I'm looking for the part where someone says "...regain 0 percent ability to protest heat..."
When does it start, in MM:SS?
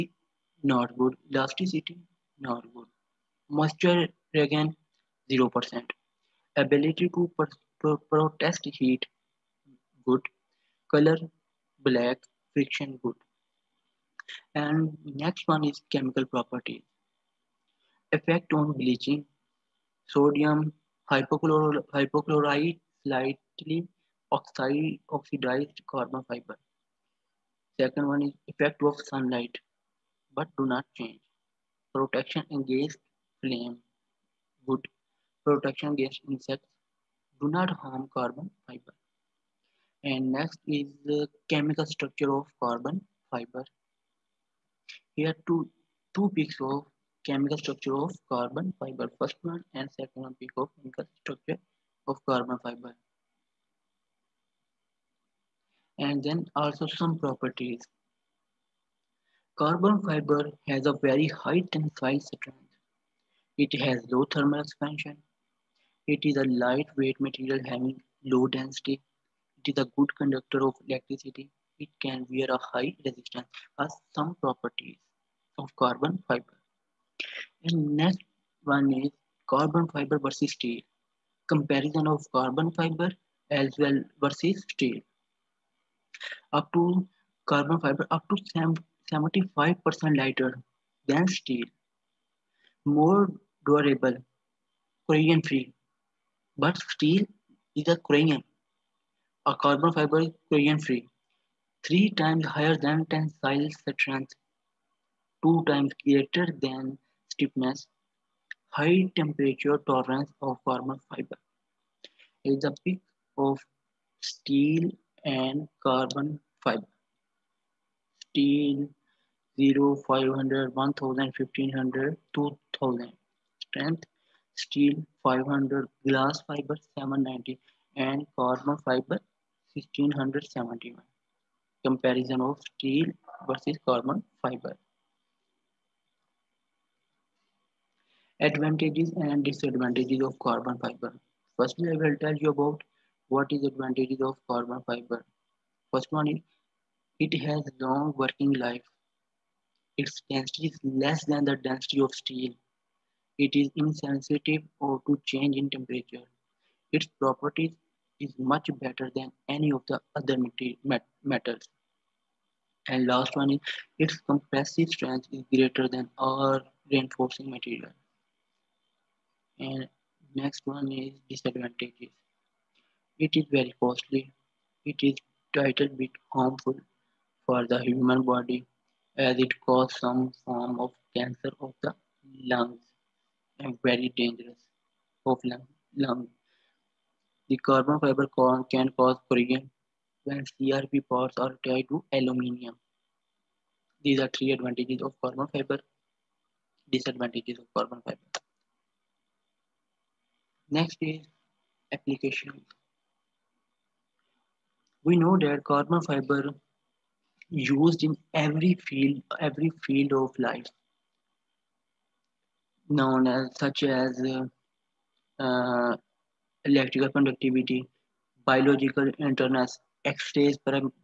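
00:04.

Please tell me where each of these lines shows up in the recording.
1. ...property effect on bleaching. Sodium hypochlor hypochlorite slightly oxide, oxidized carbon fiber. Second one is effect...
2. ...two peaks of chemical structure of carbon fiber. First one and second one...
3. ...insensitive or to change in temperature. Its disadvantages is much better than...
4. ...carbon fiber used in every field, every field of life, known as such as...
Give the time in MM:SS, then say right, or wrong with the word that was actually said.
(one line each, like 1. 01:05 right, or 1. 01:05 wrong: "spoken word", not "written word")
1. 00:16 right
2. 00:46 right
3. 02:33 wrong: "properties", not "disadvantages"
4. 03:25 right.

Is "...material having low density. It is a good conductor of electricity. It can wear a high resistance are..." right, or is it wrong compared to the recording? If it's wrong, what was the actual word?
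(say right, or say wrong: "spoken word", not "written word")
right.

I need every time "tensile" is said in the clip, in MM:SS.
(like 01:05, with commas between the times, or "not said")
01:01, 01:43.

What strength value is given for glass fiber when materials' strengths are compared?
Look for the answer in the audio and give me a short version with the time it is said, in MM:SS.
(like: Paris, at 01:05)
790, at 02:06.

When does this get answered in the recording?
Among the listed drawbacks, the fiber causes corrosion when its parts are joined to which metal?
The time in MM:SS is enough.
03:12.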